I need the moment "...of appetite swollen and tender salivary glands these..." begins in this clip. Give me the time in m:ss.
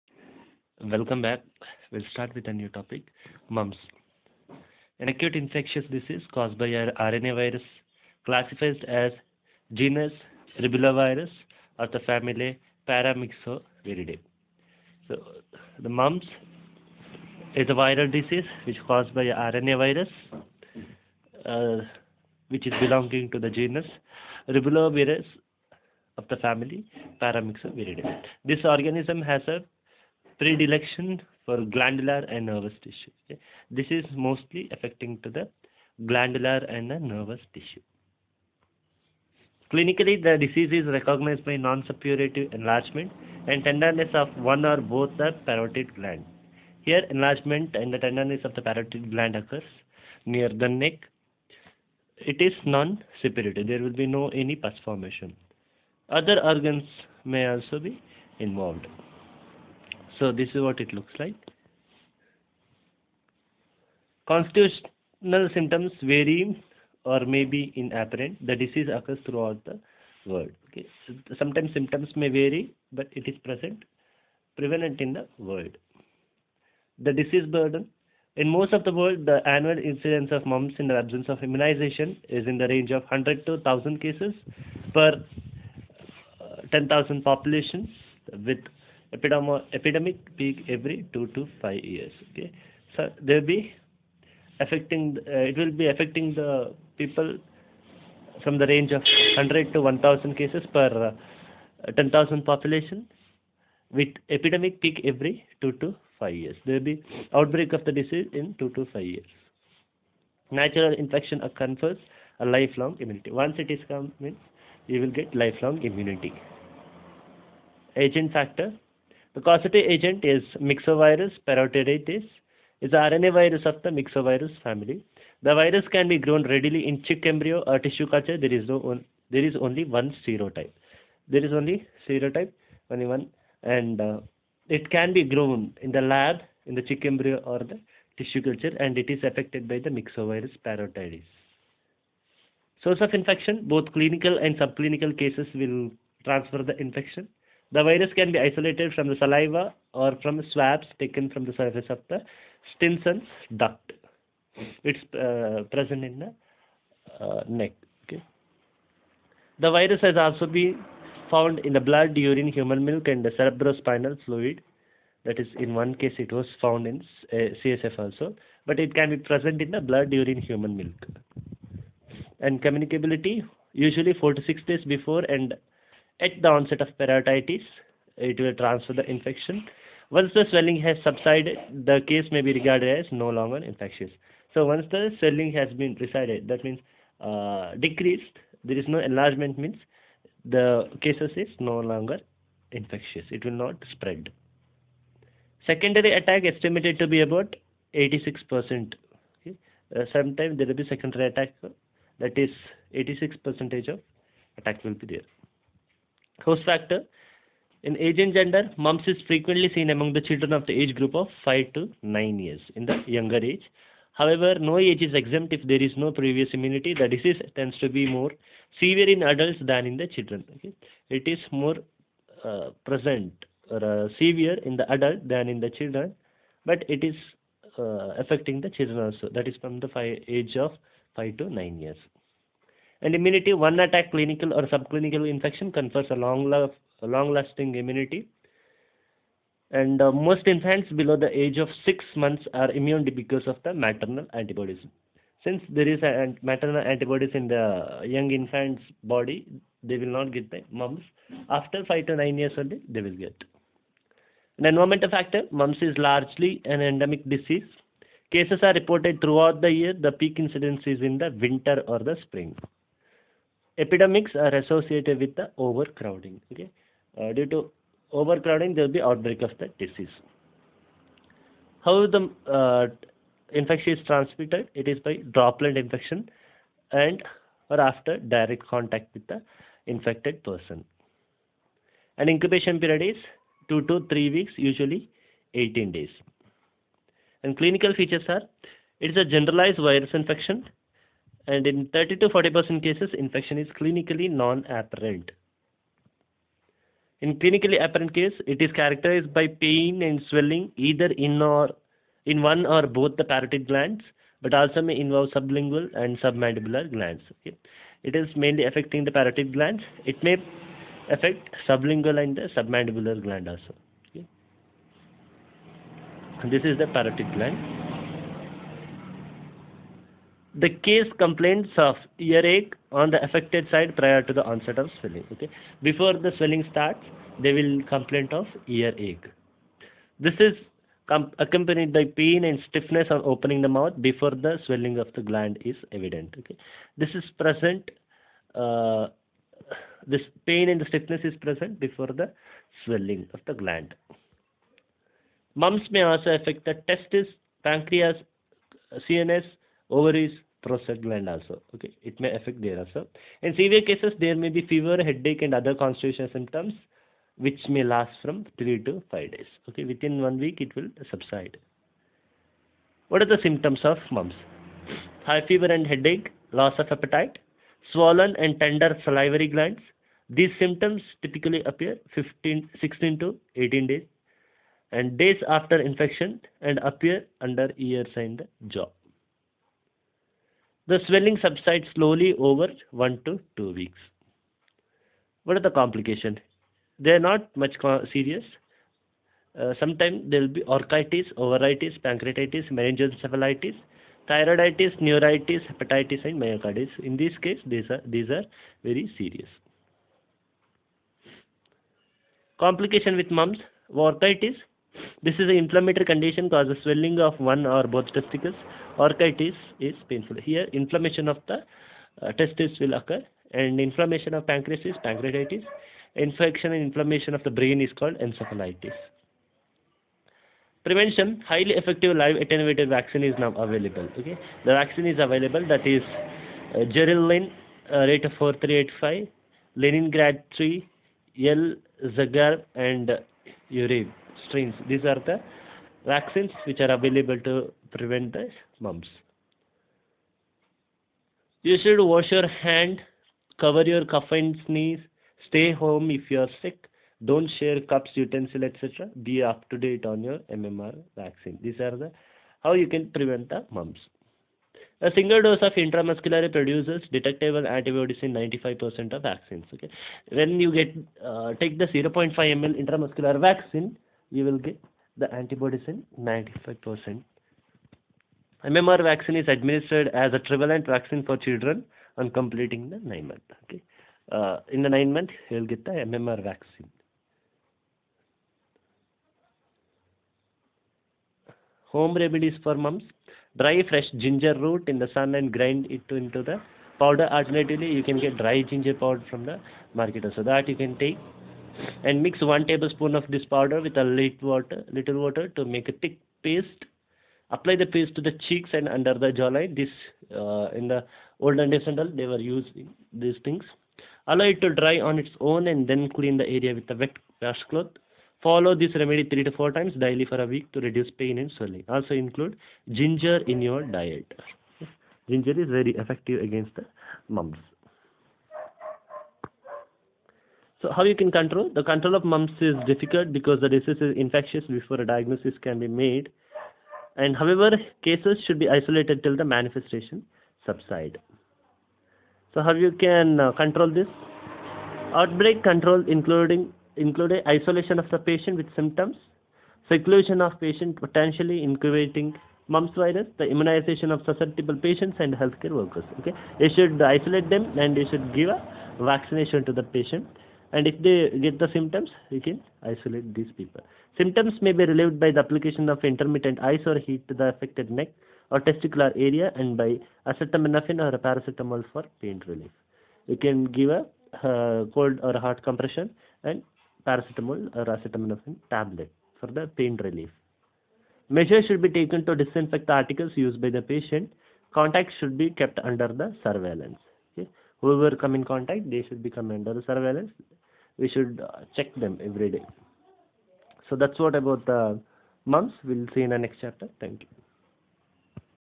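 6:06.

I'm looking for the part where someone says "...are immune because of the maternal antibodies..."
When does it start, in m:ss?
4:02.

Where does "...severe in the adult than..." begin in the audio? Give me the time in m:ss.
3:44.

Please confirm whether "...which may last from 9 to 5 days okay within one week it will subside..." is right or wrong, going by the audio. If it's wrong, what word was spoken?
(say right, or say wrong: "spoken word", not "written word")
wrong: "3", not "9".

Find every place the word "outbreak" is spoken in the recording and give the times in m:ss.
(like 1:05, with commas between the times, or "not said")
1:47, 4:29, 8:55.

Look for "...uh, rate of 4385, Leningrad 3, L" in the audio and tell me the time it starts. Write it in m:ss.
7:07.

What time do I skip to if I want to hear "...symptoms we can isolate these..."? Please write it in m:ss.
9:11.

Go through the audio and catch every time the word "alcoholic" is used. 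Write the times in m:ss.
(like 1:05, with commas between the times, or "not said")
not said.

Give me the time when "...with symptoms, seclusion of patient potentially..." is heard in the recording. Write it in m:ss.
8:58.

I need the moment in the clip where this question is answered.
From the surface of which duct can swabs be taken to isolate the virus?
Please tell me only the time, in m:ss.
2:32.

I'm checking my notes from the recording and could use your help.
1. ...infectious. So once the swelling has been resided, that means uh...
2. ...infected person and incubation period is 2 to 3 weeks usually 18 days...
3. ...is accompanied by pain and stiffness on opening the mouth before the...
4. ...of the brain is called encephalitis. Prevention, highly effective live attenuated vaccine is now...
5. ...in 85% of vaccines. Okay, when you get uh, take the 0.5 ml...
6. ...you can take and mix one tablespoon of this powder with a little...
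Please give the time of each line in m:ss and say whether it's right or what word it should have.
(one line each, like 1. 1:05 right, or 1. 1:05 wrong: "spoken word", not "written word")
1. 3:03 right
2. 4:39 right
3. 5:30 right
4. 6:57 right
5. 7:38 wrong: "95", not "85"
6. 8:10 right.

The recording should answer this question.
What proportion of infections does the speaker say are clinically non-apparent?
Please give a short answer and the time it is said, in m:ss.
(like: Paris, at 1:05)
30 to 40%, at 4:51.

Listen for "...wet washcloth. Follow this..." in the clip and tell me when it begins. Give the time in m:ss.
8:26.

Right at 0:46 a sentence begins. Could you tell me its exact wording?
Here, enlargement and the tenderness of the parotid gland occurs near the neck.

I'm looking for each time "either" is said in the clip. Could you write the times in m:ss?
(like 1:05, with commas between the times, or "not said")
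5:00.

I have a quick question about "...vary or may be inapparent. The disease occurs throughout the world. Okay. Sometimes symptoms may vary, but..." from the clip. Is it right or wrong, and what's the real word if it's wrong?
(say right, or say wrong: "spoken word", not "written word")
right.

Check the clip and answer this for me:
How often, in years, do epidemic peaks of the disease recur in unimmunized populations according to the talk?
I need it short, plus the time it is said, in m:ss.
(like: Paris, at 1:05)
every 2 to 5 years, at 1:30.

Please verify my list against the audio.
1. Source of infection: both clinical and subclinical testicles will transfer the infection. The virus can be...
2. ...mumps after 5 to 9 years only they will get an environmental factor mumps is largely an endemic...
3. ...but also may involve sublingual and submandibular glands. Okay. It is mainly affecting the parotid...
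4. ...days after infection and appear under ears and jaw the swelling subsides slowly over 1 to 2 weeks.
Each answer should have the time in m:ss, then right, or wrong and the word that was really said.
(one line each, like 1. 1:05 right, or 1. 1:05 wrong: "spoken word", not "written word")
1. 2:22 wrong: "cases", not "testicles"
2. 4:10 right
3. 5:04 right
4. 6:15 right.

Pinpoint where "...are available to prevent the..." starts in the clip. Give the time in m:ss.
7:16.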